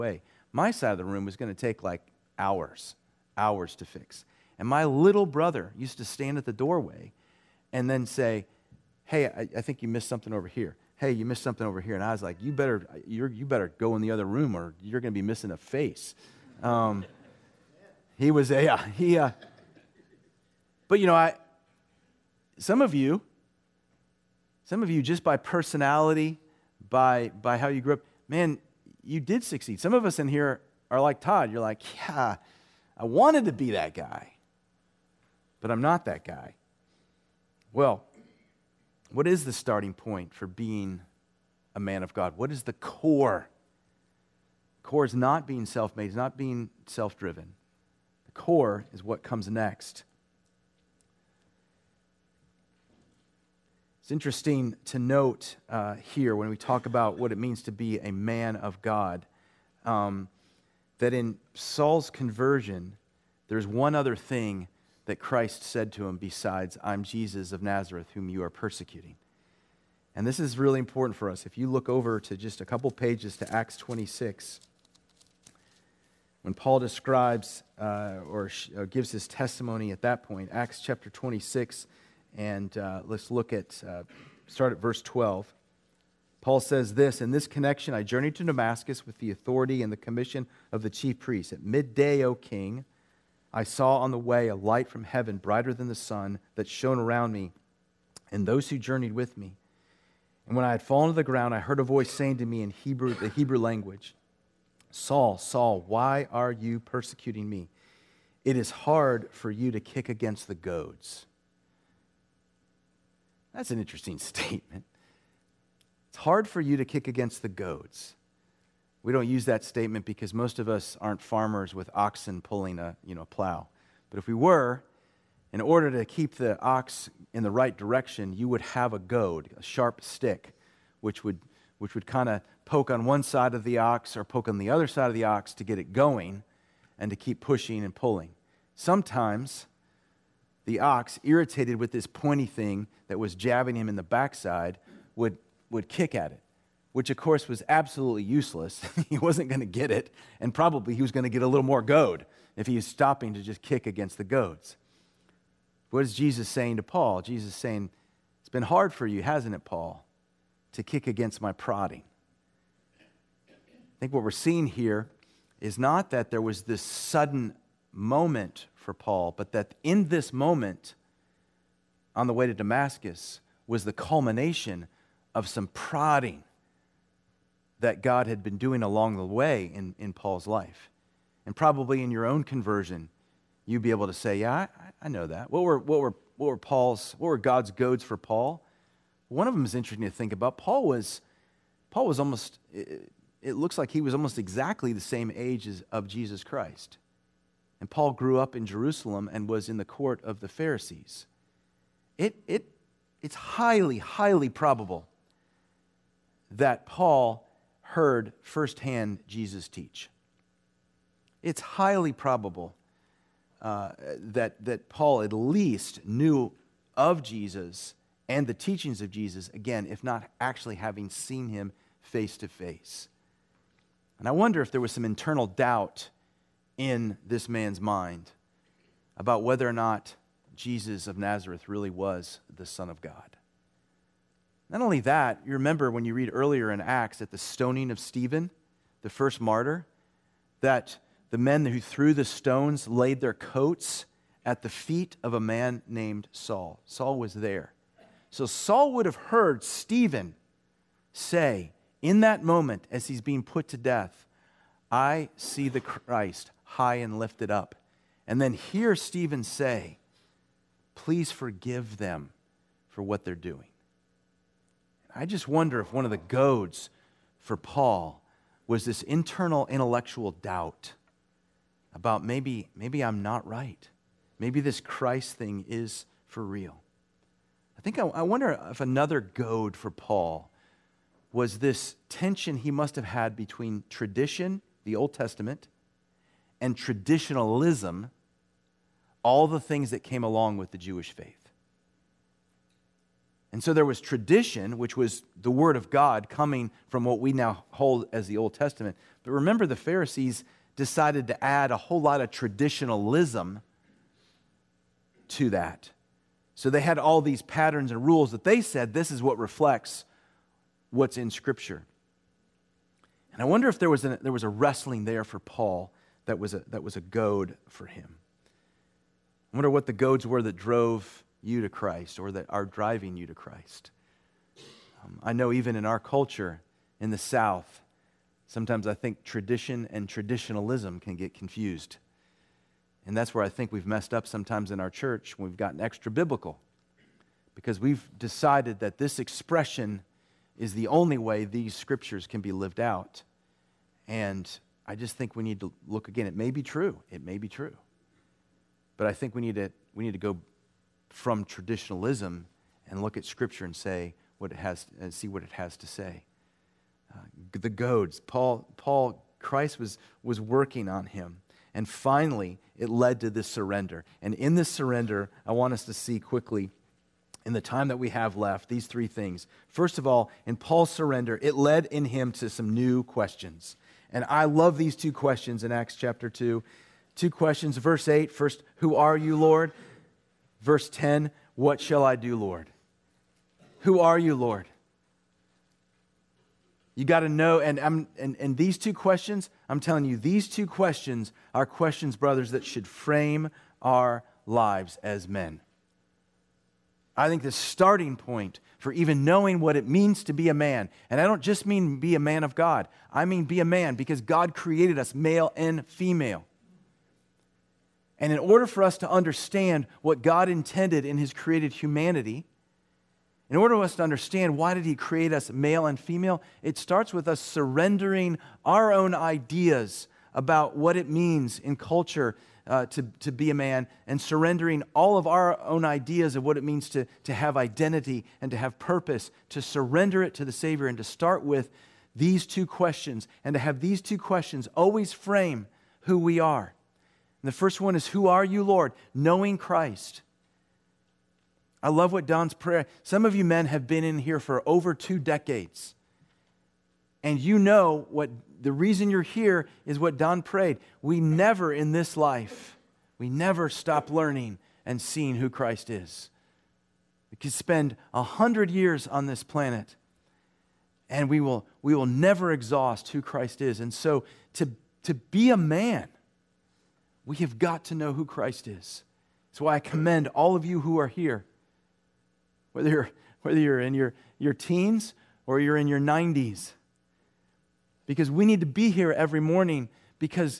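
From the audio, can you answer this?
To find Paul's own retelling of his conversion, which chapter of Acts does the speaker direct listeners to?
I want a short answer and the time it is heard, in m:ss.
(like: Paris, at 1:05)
Acts 26, at 1:13.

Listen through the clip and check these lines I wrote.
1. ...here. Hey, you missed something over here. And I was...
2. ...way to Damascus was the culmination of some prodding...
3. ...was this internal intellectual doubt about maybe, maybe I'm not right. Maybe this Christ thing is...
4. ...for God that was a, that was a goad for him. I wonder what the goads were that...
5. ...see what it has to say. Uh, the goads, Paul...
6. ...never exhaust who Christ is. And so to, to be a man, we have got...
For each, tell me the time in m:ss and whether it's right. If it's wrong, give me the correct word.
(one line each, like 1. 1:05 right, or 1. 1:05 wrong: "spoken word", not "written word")
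1. 0:10 right
2. 2:52 right
3. 4:28 right
4. 5:15 wrong: "Paul", not "God"
5. 5:55 right
6. 7:42 right.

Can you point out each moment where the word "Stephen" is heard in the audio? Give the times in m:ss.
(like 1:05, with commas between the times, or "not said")
3:57, 4:09, 4:18.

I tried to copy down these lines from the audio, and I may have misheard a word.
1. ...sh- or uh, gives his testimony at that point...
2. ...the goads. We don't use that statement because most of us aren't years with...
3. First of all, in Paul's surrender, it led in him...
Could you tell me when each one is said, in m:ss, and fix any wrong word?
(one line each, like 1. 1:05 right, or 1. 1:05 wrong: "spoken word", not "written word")
1. 1:18 right
2. 1:57 wrong: "farmers", not "years"
3. 6:09 right.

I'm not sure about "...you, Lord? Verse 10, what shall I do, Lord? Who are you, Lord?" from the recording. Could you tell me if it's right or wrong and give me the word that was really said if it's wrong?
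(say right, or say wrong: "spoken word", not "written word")
right.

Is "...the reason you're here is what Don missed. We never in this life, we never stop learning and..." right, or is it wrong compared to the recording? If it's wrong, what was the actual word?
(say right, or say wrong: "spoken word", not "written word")
wrong: "prayed", not "missed".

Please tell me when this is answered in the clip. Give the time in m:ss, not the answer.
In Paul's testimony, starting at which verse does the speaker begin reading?
1:24.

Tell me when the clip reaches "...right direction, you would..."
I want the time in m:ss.
2:07.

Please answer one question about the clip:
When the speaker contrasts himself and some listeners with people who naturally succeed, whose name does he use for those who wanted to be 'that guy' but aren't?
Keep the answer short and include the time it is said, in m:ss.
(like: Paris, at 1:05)
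Todd, at 0:31.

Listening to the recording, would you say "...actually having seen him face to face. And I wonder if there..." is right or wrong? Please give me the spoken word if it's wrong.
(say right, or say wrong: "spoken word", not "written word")
right.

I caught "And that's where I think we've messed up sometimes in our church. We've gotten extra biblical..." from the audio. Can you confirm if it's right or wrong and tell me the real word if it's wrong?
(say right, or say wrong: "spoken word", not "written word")
right.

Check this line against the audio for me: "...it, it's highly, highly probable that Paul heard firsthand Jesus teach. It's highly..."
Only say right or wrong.
right.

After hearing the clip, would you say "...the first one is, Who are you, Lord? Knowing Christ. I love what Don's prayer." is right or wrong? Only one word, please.
right.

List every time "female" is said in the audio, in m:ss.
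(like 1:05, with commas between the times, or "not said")
6:45, 6:55.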